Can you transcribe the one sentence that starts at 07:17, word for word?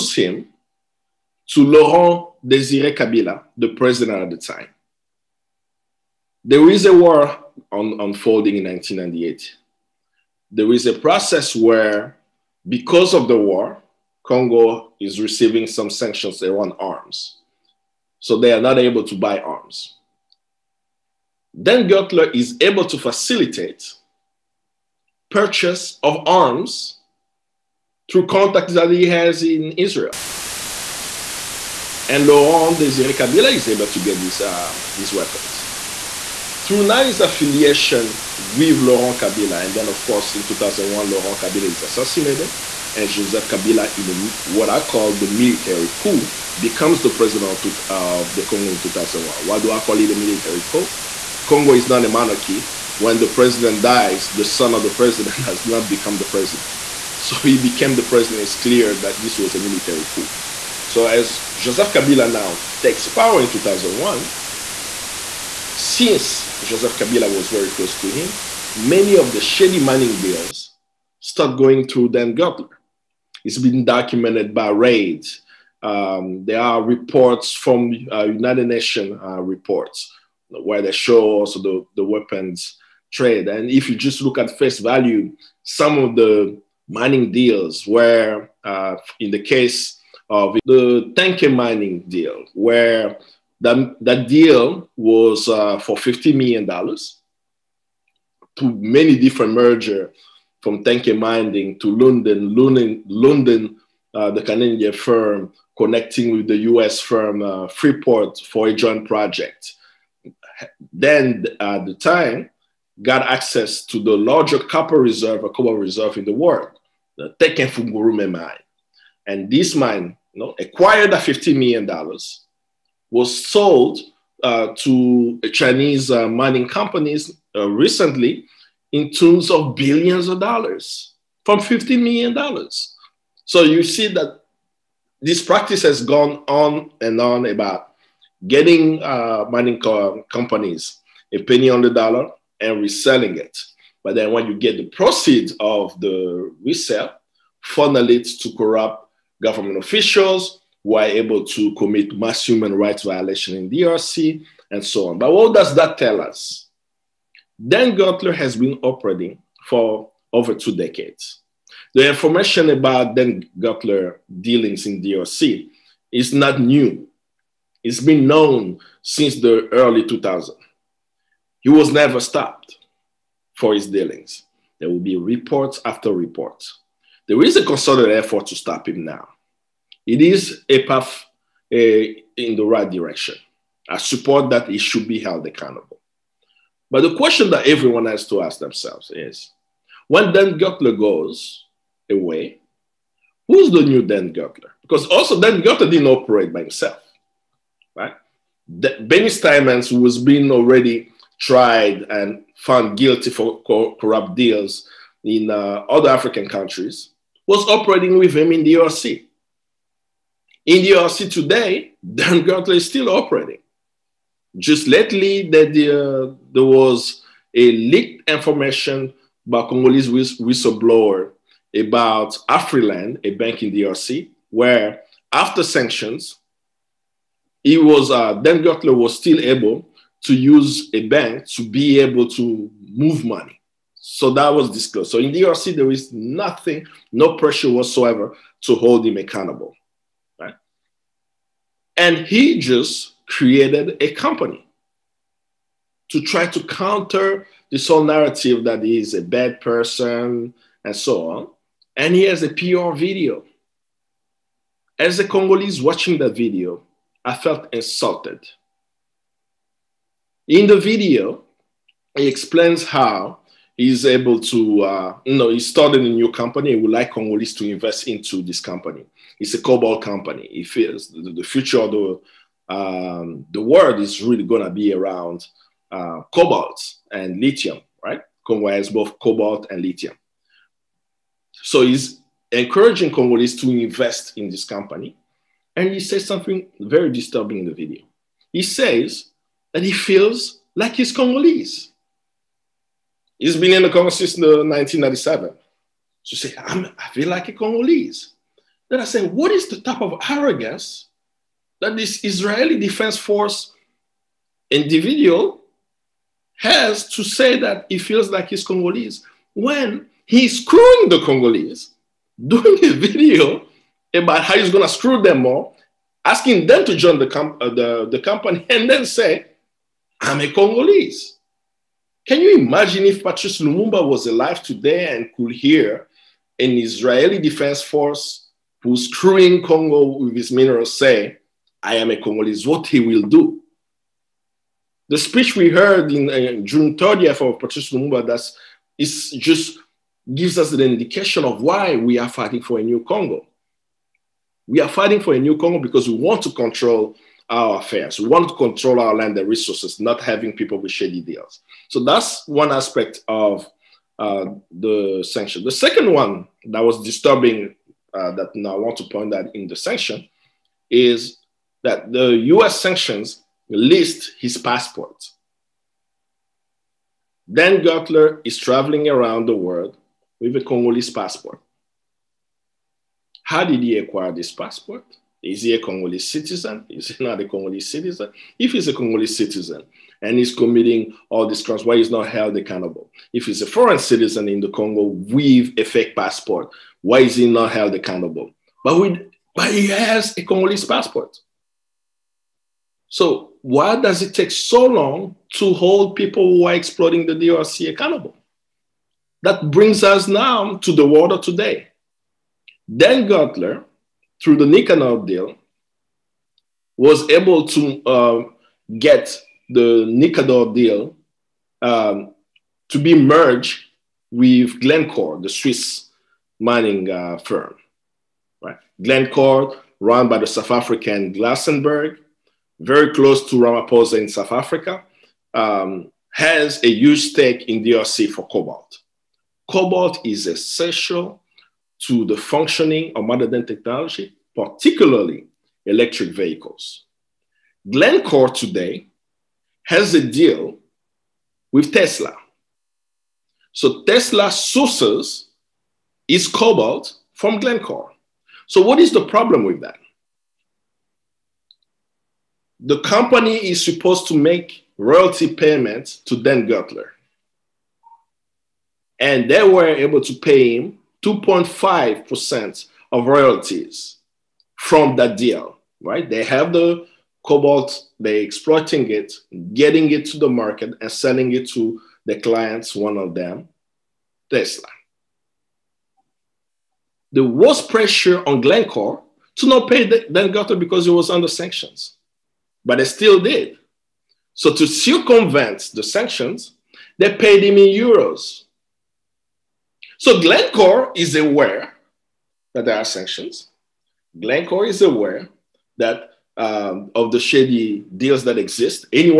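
Glencore today has a deal with Tesla.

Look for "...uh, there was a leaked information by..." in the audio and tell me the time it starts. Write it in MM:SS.
03:36.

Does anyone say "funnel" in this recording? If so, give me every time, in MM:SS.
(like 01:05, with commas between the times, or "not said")
02:27.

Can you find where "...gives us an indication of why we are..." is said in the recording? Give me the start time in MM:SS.
05:40.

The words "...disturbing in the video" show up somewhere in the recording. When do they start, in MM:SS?
04:47.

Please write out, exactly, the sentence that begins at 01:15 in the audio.
Um, there are reports from uh, United Nations uh, reports where they show also the, the weapons trade.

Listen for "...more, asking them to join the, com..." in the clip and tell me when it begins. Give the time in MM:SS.
05:15.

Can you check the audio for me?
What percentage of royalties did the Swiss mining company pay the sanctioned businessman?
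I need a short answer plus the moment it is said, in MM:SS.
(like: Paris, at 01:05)
2.5%, at 07:41.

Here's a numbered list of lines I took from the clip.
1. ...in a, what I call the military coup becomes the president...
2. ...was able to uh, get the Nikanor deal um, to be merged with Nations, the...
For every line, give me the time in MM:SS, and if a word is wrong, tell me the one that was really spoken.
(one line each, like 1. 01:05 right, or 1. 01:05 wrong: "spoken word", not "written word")
1. 00:43 right
2. 06:46 wrong: "Glencore", not "Nations".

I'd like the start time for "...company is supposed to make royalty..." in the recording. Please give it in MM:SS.
07:32.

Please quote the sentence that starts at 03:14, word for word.
Because also Dan Gertler didn't operate by himself, right?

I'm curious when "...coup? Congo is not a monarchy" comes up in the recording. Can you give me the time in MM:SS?
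00:50.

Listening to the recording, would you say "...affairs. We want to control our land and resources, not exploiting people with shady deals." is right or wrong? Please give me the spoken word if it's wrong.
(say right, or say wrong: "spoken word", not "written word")
wrong: "having", not "exploiting".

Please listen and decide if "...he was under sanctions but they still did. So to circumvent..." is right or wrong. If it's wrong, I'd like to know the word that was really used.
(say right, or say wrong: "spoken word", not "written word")
right.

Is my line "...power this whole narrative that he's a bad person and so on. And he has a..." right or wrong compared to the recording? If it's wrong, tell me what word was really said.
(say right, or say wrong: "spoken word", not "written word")
wrong: "counter", not "power".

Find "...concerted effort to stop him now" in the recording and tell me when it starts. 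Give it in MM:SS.
02:57.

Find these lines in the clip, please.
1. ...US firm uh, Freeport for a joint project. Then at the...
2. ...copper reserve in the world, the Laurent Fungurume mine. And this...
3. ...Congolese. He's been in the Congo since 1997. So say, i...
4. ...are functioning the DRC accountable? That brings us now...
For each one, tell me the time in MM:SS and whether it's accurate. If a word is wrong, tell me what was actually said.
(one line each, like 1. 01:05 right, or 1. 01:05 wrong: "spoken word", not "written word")
1. 01:46 right
2. 01:55 wrong: "Tenke", not "Laurent"
3. 04:51 right
4. 06:36 wrong: "exploiting", not "functioning".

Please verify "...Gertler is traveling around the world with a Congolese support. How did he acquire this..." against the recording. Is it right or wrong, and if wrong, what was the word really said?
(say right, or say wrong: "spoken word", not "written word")
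wrong: "passport", not "support".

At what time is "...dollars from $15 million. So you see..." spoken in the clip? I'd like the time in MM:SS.
02:10.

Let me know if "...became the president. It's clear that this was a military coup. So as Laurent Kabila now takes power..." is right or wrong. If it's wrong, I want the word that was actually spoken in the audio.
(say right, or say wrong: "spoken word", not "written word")
wrong: "Joseph", not "Laurent".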